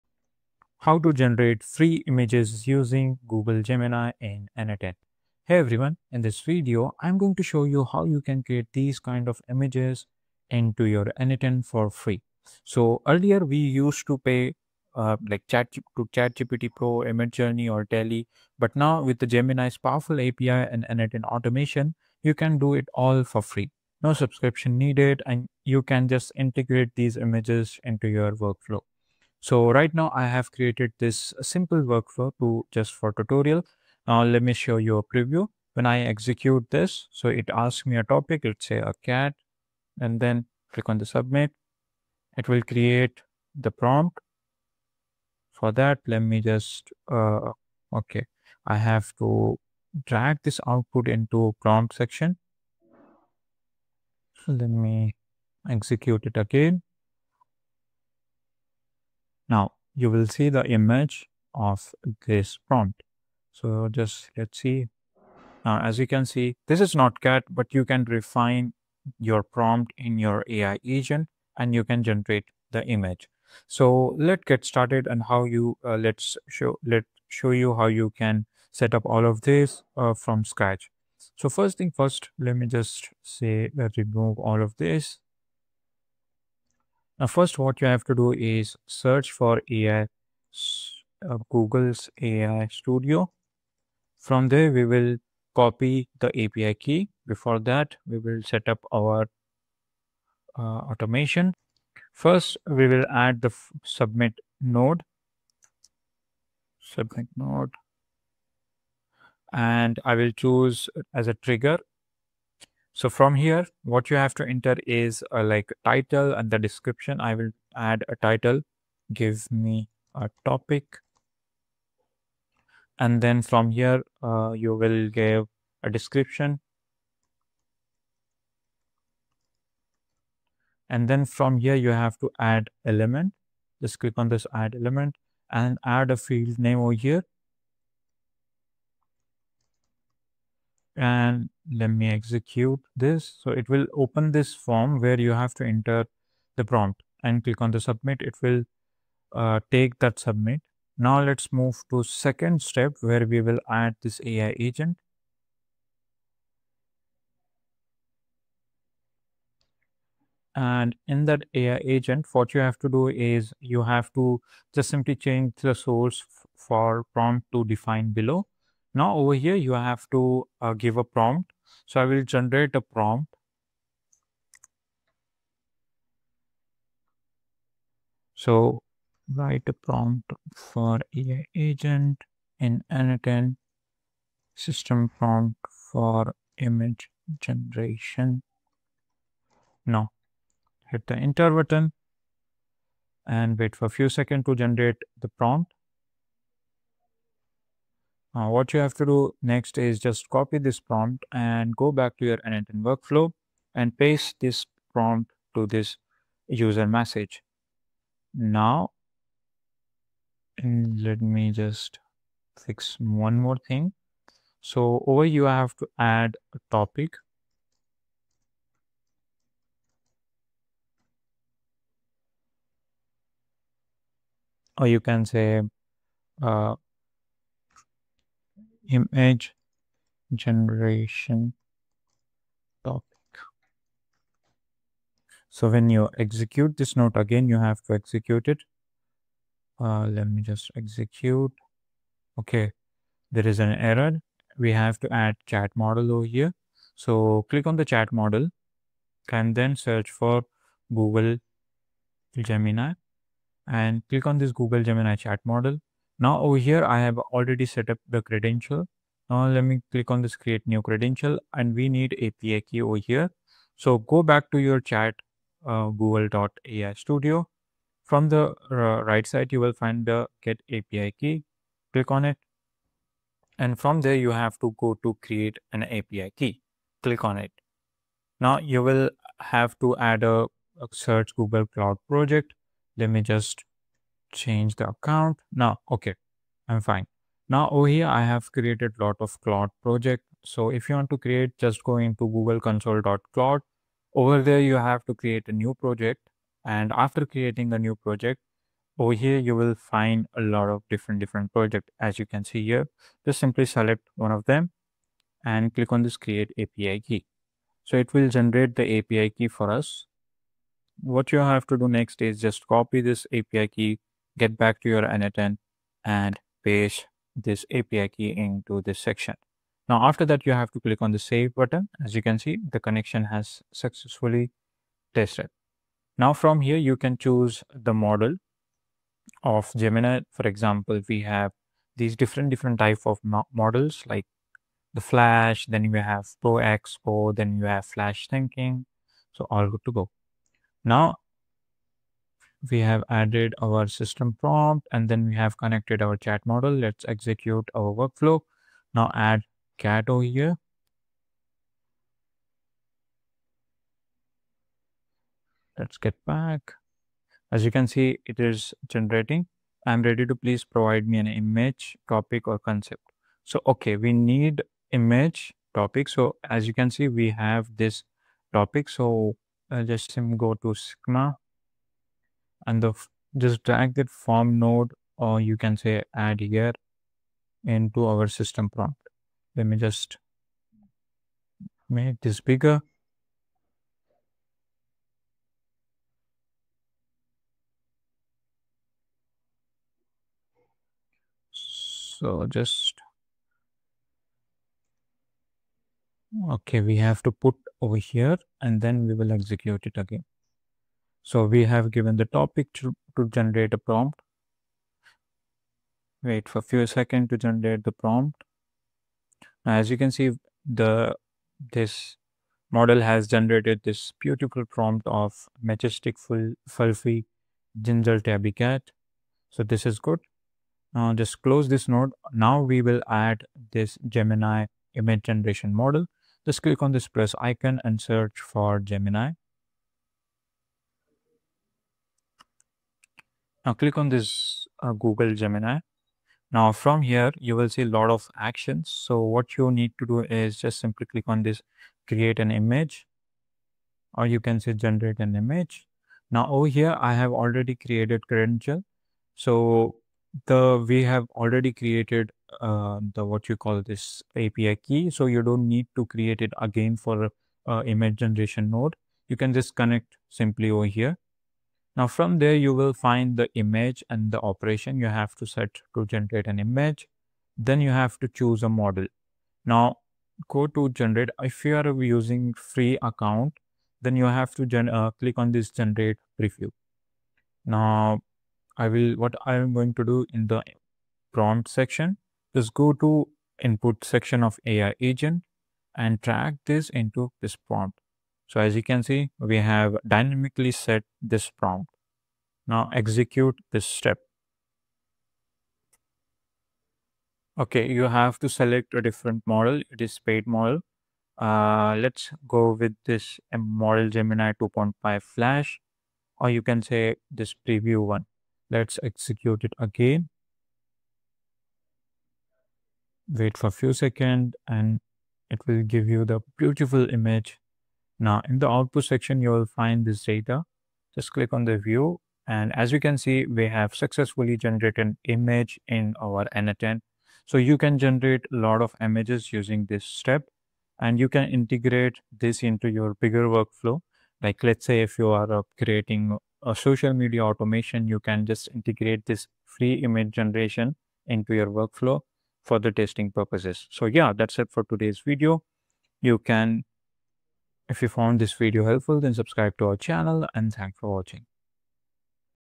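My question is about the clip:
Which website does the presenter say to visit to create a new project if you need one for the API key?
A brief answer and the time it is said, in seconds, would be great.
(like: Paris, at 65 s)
Google Console.cloud, at 292 s.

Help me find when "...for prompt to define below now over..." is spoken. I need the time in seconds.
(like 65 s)
166 s.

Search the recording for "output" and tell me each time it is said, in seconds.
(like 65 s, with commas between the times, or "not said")
50 s, 518 s.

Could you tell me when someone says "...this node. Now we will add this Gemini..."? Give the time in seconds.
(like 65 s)
421 s.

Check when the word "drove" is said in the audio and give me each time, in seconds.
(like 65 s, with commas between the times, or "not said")
not said.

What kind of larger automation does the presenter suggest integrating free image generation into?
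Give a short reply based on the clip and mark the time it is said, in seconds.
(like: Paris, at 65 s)
Social media automation, at 536 s.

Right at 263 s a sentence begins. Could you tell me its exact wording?
So go back to your chat uh, google.ai studio.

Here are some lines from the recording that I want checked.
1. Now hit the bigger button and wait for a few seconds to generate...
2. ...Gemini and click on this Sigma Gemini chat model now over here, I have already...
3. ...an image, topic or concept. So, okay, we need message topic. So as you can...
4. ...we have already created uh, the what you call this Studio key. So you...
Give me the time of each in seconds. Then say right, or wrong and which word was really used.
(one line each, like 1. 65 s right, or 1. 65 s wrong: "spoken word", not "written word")
1. 189 s wrong: "enter", not "bigger"
2. 252 s wrong: "Google", not "Sigma"
3. 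361 s wrong: "image", not "message"
4. 450 s wrong: "API", not "Studio".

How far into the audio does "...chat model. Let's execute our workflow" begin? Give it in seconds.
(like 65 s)
346 s.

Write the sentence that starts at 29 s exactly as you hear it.
So right now I have created this simple workflow to just for tutorial.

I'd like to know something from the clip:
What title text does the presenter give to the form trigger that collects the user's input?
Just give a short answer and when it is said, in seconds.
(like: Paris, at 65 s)
Give me a topic, at 119 s.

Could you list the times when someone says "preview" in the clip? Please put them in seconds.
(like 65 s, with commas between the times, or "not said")
35 s, 476 s, 507 s.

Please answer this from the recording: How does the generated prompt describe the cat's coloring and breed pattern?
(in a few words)
ginger tabby.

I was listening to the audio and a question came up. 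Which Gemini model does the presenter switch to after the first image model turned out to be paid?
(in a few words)
Gemini 2.5 Flash.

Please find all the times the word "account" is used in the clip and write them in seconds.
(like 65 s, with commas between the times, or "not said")
284 s, 473 s.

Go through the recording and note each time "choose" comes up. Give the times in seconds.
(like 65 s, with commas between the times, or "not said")
110 s, 327 s, 468 s.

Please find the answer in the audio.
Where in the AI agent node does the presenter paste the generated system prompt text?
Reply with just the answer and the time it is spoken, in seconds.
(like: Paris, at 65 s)
User message, at 206 s.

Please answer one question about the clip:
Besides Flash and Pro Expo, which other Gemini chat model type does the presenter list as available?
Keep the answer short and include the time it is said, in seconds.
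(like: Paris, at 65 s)
Flash Thinking, at 337 s.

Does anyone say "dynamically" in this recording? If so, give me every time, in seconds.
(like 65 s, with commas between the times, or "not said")
490 s.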